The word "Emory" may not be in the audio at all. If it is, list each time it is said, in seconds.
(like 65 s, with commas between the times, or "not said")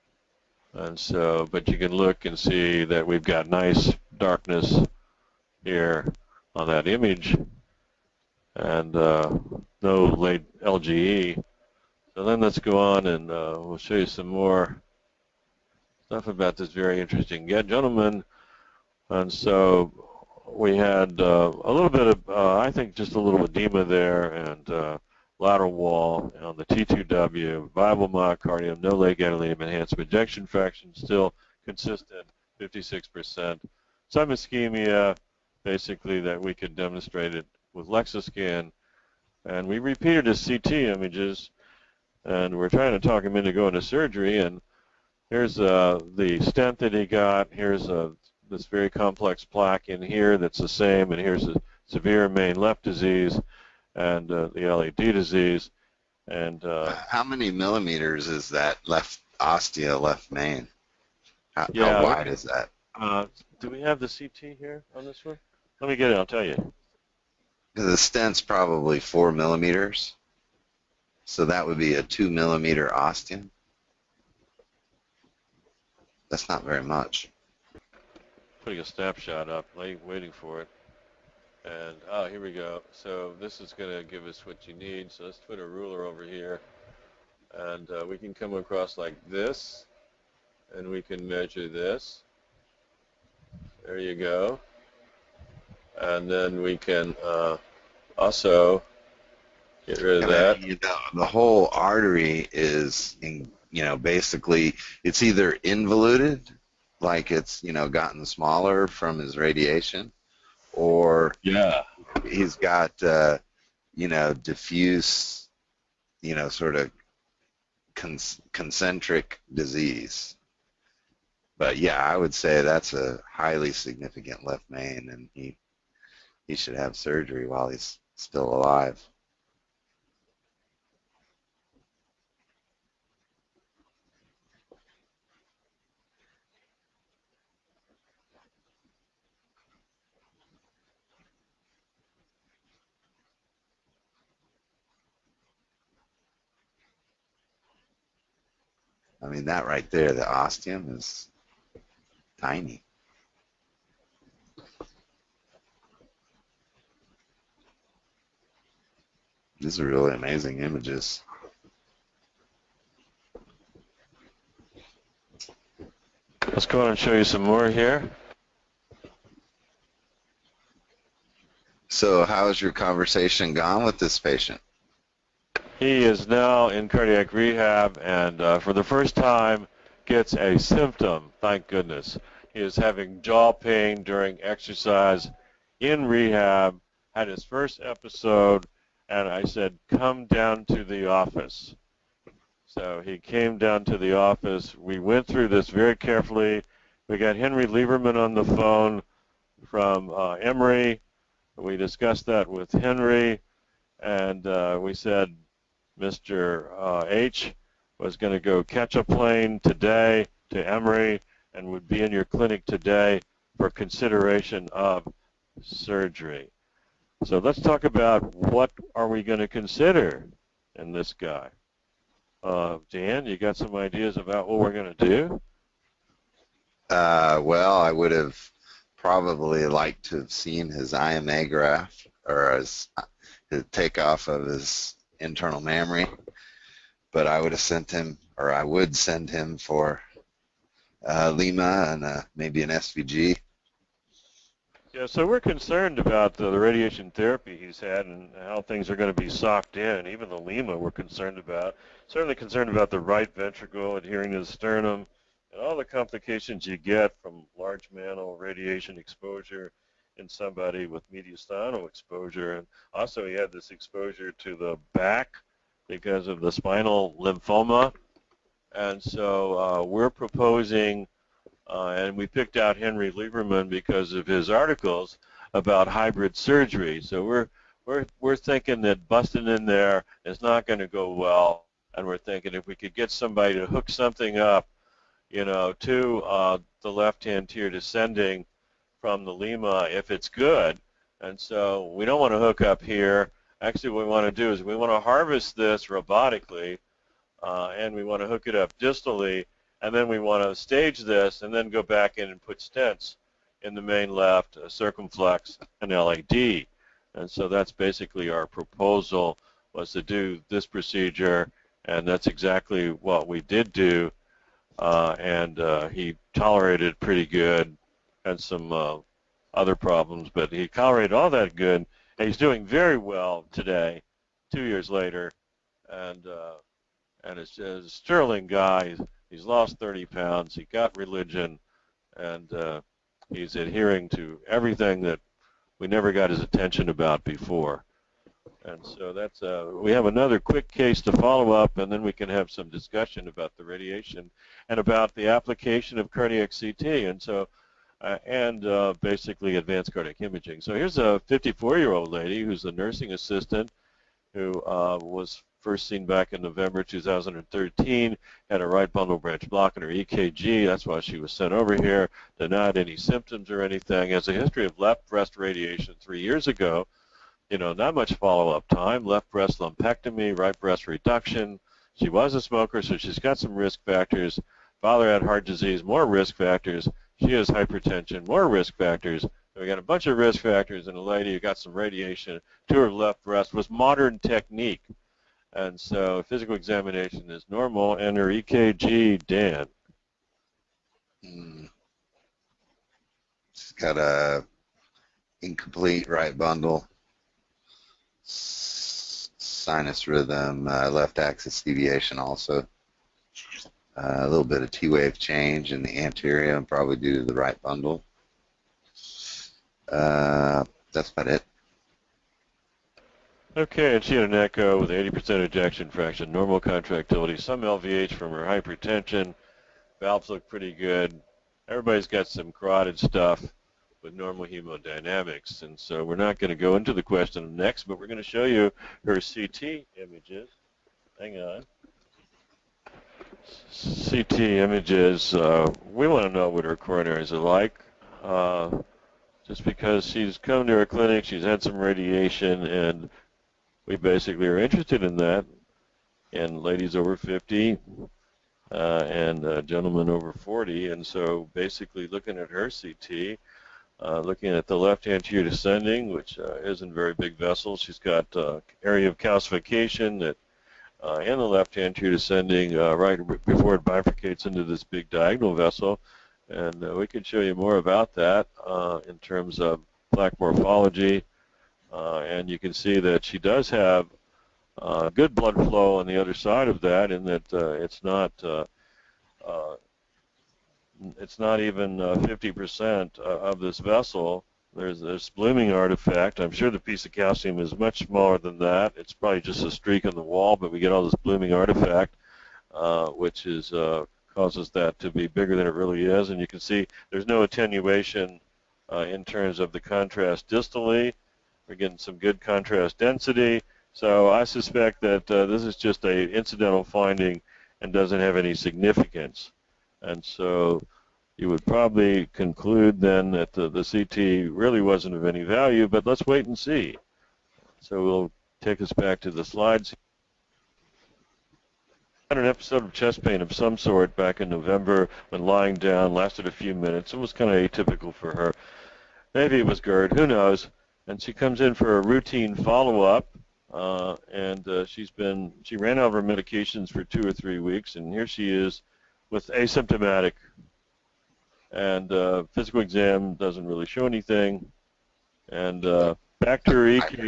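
200 s, 210 s.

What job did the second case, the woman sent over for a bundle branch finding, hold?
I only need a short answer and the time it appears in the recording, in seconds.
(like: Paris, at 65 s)
nursing assistant, at 352 s.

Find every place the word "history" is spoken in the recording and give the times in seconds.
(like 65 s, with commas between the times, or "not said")
364 s.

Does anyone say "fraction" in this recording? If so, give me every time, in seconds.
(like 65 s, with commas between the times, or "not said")
30 s, 415 s.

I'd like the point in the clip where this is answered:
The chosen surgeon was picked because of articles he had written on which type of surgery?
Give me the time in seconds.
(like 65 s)
275 s.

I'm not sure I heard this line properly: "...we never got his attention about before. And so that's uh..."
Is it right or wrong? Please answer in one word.
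right.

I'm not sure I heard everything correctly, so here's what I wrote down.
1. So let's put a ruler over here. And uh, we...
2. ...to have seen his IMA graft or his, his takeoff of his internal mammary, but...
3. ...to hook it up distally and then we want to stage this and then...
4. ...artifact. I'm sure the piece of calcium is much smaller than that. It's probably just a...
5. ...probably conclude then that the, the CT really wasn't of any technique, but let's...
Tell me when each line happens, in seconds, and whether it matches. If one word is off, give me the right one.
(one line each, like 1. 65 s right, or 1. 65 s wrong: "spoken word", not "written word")
1. 85 s right
2. 230 s right
3. 298 s right
4. 485 s right
5. 511 s wrong: "value", not "technique".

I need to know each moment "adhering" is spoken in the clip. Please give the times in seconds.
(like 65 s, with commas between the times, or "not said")
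253 s, 333 s.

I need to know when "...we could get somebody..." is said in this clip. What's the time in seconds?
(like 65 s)
282 s.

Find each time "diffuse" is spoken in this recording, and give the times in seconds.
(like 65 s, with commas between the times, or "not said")
114 s.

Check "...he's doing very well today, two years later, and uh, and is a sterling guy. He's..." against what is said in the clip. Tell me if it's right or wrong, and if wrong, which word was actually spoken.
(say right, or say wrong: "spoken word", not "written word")
right.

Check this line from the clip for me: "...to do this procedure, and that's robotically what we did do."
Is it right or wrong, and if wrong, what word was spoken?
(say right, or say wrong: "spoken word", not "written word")
wrong: "exactly", not "robotically".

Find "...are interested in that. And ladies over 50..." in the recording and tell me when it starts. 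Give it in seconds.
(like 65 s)
444 s.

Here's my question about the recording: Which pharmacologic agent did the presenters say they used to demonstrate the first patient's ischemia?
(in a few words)
Lexiscan.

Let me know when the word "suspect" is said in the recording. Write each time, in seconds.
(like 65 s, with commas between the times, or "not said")
504 s.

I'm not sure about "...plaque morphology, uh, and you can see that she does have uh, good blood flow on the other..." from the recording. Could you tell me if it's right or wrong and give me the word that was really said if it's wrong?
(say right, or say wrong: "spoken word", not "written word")
right.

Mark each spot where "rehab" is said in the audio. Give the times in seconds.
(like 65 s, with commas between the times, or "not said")
177 s, 186 s.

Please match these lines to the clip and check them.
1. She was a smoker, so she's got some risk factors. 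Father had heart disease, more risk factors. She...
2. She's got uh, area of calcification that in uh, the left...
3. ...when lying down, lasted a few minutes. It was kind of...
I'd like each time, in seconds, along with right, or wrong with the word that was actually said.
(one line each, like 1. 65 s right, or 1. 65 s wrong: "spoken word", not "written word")
1. 371 s right
2. 457 s right
3. 525 s right.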